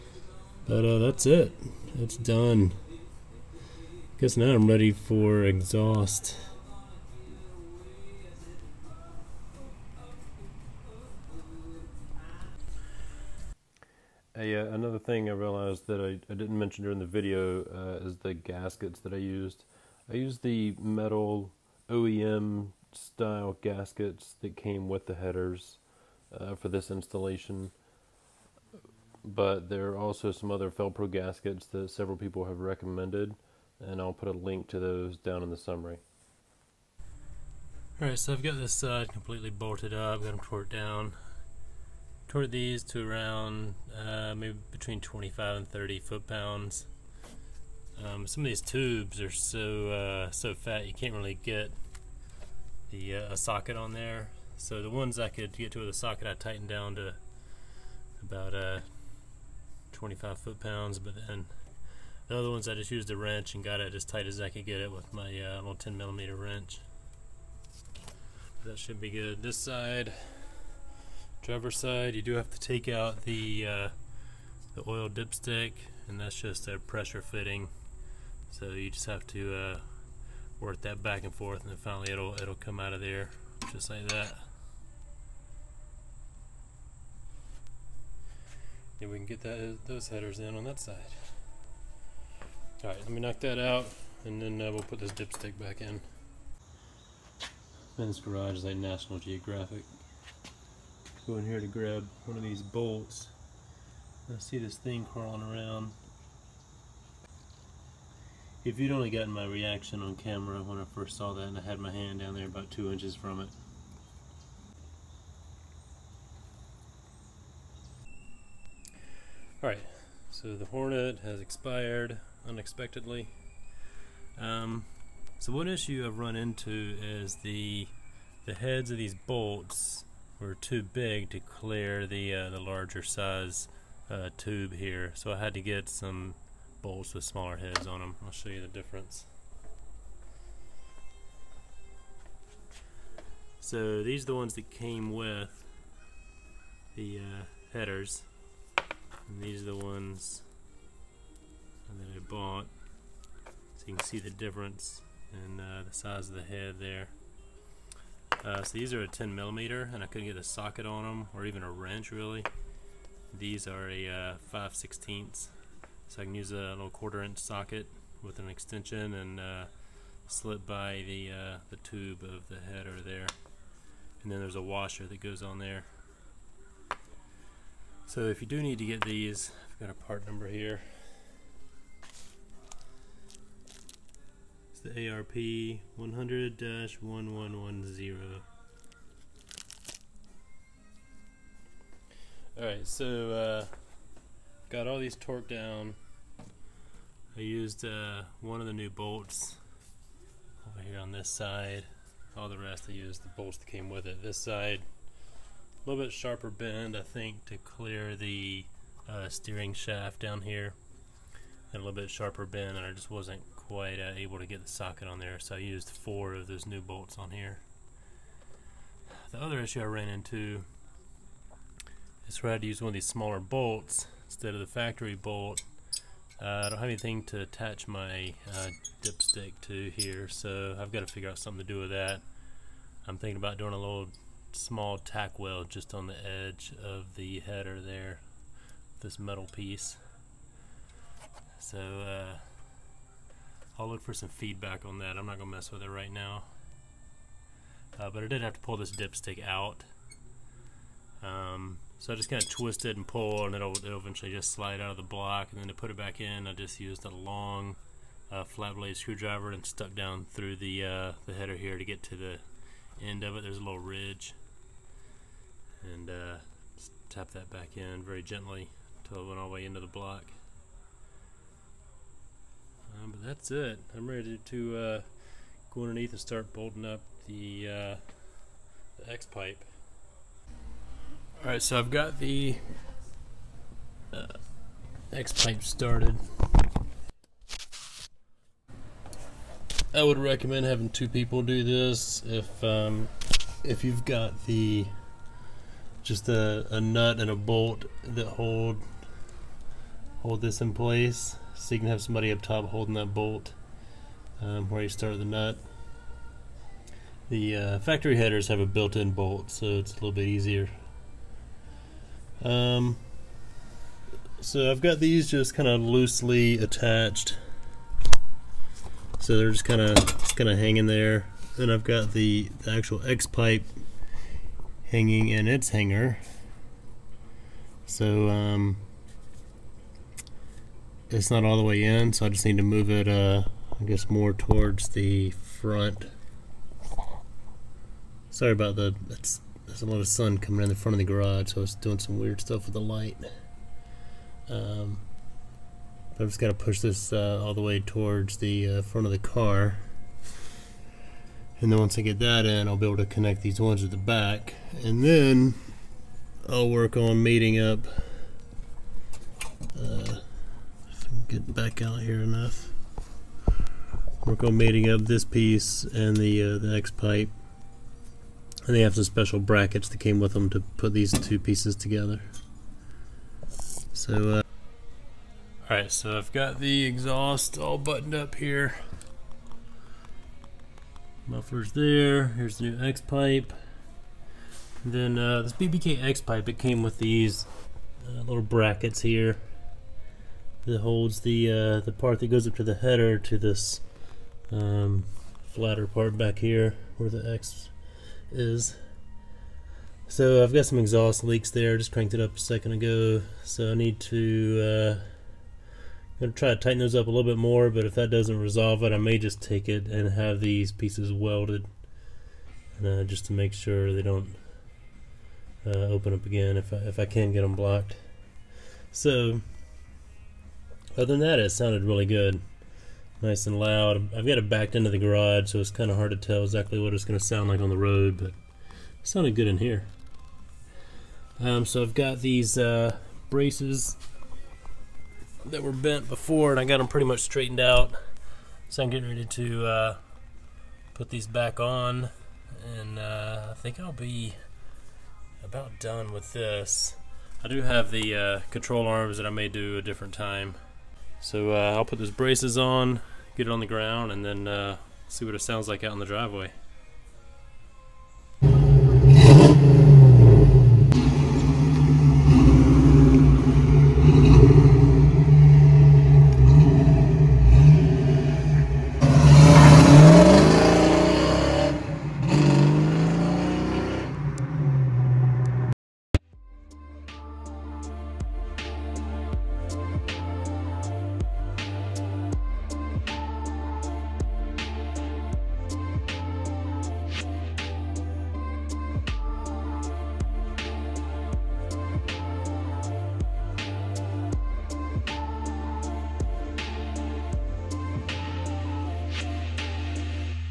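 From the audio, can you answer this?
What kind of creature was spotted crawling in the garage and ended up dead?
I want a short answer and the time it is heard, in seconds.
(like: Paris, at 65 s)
Hornet, at 120 s.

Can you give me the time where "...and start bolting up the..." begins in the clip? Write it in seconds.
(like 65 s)
276 s.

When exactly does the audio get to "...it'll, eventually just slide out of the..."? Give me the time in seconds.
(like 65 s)
253 s.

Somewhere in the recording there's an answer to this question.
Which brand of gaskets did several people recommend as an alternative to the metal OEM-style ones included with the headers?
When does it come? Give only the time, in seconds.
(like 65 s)
30 s.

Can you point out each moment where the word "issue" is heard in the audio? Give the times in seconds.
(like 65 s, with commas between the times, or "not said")
125 s, 219 s.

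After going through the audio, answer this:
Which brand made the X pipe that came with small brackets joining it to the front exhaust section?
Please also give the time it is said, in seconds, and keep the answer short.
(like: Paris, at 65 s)
BBK, at 385 s.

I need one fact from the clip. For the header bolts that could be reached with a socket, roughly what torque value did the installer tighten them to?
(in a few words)
25 foot-pounds.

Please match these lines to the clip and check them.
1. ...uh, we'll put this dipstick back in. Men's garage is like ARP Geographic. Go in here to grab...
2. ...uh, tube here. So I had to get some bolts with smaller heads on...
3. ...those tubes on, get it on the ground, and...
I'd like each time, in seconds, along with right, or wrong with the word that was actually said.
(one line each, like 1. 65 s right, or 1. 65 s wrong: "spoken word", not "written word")
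1. 94 s wrong: "National", not "ARP"
2. 134 s right
3. 451 s wrong: "braces", not "tubes".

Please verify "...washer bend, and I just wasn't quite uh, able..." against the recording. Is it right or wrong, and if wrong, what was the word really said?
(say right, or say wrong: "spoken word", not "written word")
wrong: "sharper", not "washer".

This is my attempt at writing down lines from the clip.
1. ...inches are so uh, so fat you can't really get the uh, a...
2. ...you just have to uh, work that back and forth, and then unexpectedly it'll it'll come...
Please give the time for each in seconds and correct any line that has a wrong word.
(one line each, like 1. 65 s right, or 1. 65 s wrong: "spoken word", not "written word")
1. 48 s wrong: "tubes", not "inches"
2. 78 s wrong: "finally", not "unexpectedly".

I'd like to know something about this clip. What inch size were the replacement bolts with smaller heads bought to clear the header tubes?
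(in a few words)
5/16.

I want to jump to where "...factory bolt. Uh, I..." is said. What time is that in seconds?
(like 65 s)
224 s.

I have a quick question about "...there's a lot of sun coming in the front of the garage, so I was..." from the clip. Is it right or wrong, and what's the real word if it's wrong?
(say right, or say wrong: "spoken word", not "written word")
right.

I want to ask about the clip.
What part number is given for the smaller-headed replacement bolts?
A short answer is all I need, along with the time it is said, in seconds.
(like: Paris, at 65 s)
ARP 100-1110, at 185 s.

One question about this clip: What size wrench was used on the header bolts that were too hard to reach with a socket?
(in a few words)
10 millimeter.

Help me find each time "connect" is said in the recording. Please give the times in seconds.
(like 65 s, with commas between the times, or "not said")
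353 s.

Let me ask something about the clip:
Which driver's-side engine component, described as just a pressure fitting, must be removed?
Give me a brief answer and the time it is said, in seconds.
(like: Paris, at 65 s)
oil dipstick, at 74 s.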